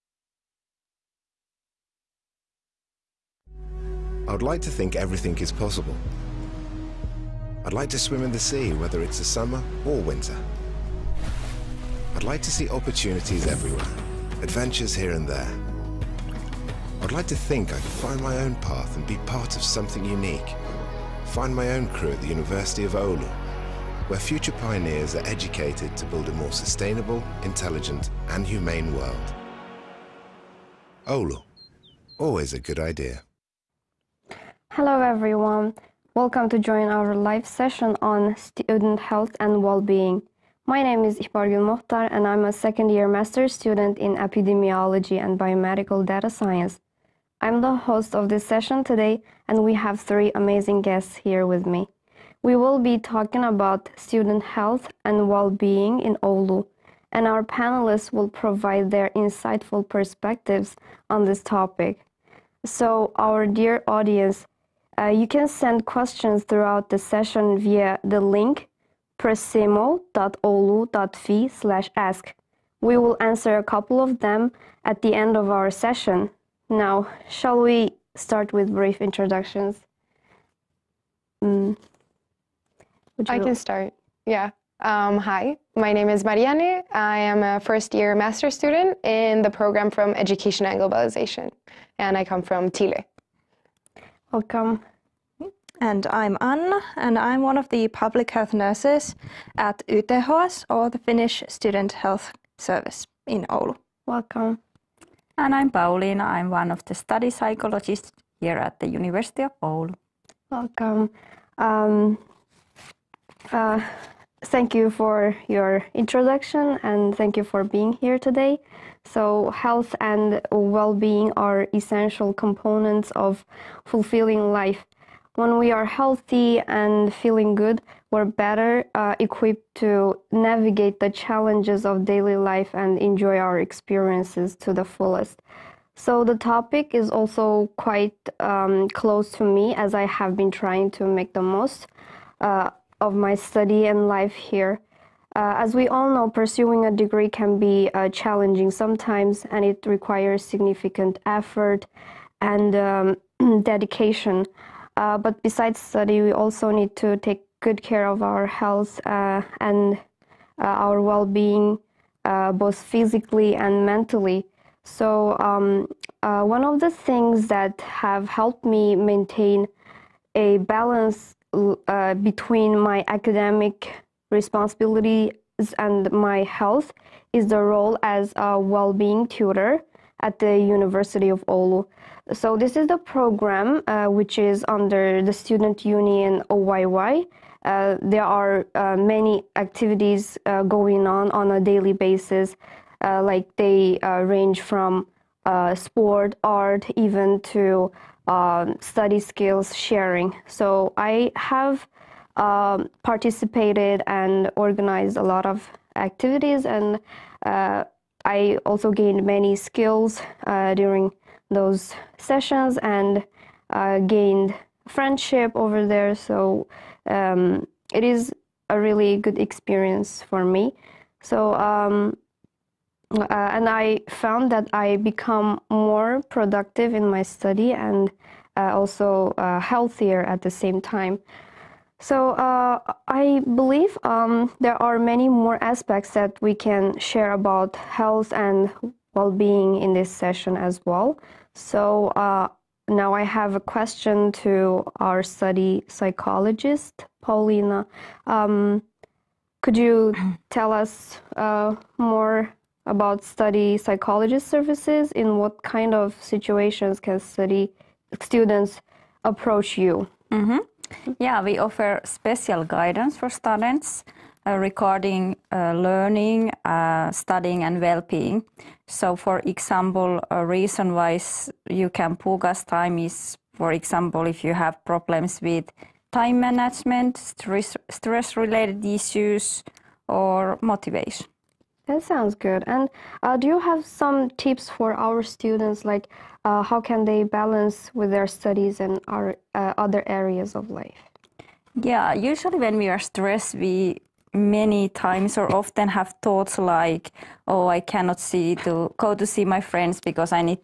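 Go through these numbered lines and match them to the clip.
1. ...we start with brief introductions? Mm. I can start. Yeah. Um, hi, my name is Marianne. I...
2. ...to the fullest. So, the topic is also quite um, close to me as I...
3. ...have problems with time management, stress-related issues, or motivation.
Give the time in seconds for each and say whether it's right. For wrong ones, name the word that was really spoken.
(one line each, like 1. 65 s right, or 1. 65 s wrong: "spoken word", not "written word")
1. 77 s right
2. 134 s right
3. 274 s right.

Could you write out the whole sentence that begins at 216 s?
So um, it is a really good experience for me.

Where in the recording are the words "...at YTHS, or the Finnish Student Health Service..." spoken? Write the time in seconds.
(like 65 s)
99 s.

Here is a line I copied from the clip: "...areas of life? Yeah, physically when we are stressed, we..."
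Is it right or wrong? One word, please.
wrong.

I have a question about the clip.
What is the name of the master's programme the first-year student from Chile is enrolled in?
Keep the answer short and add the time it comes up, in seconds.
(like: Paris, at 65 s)
Education and Globalization, at 90 s.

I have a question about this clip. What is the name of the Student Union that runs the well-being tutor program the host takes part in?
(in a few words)
OYY.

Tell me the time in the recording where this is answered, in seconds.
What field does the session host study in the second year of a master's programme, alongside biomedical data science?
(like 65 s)
44 s.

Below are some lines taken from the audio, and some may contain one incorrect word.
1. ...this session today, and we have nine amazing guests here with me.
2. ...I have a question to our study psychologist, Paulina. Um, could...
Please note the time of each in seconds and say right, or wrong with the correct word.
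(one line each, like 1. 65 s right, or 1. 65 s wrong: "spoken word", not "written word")
1. 48 s wrong: "three", not "nine"
2. 243 s right.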